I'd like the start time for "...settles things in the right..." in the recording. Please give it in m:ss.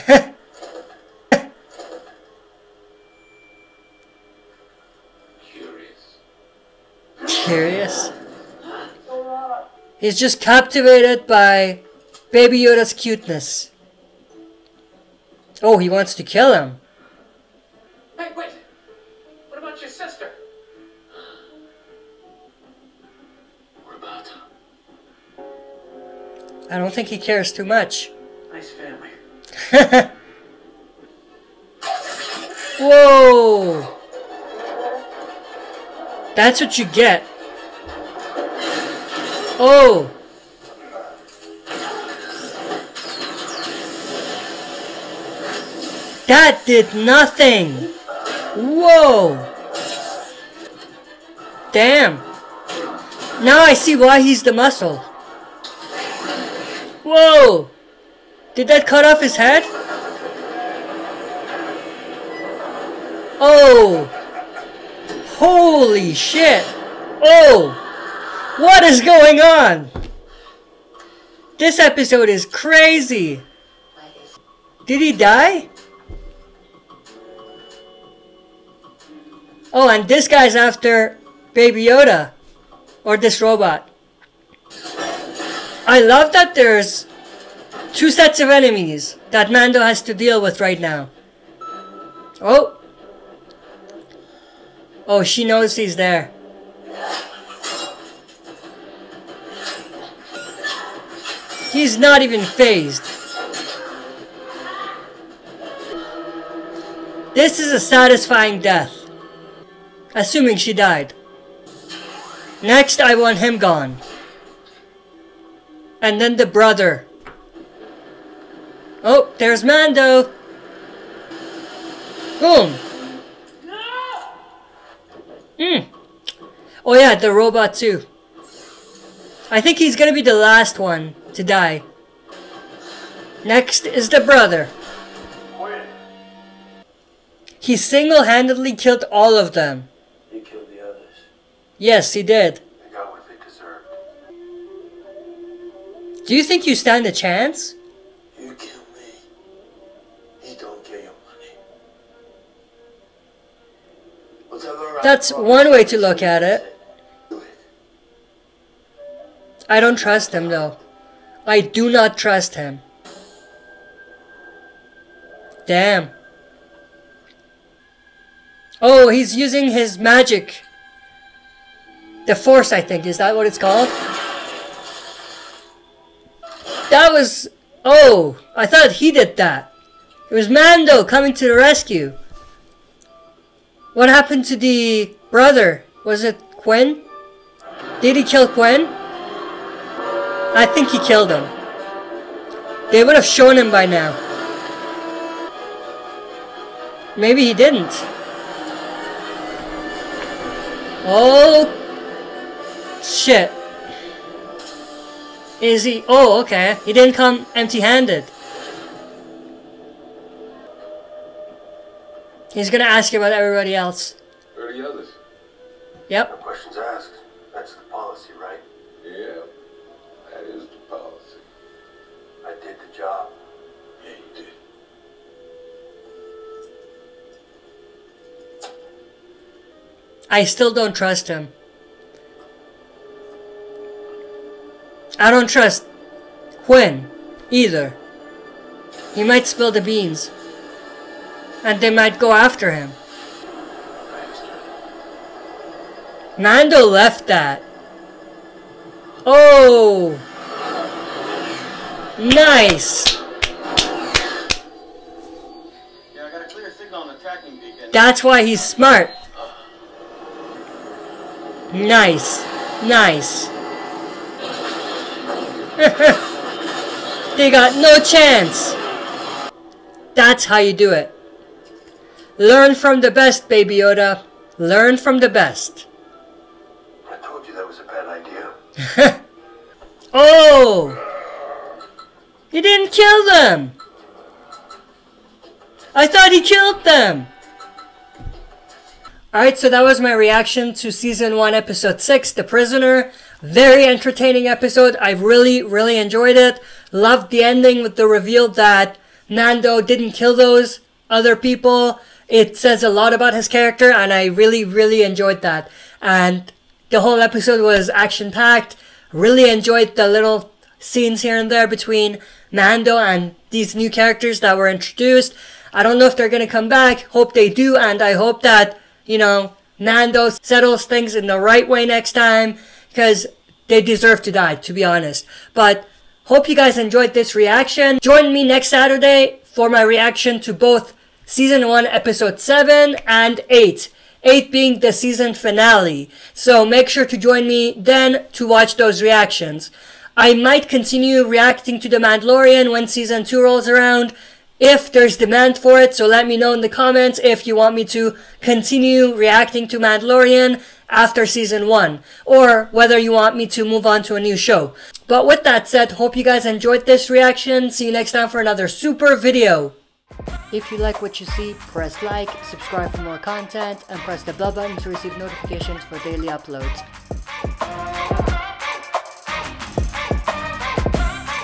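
5:20.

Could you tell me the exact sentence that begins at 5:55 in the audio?
But with that said, hope you guys enjoyed this reaction.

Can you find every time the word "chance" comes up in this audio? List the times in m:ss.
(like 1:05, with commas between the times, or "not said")
2:27, 4:28.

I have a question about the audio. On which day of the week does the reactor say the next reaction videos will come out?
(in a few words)
Saturday.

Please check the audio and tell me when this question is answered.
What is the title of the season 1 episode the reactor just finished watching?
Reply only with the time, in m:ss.
4:52.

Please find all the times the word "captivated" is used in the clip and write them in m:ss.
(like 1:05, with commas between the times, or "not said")
0:10.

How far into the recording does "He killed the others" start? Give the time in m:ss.
2:20.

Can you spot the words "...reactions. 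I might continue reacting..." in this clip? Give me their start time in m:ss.
5:39.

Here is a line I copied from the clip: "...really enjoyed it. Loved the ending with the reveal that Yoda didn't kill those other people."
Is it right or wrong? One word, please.
wrong.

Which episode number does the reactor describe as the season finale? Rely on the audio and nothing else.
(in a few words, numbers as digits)
8.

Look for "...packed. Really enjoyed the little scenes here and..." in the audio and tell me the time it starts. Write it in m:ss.
5:08.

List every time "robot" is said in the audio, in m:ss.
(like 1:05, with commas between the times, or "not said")
1:23, 2:07.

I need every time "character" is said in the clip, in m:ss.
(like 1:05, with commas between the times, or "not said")
5:03, 5:13.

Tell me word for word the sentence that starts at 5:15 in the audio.
I don't know if they're gonna come back.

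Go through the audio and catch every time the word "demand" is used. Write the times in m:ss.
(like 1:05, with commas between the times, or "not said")
5:45.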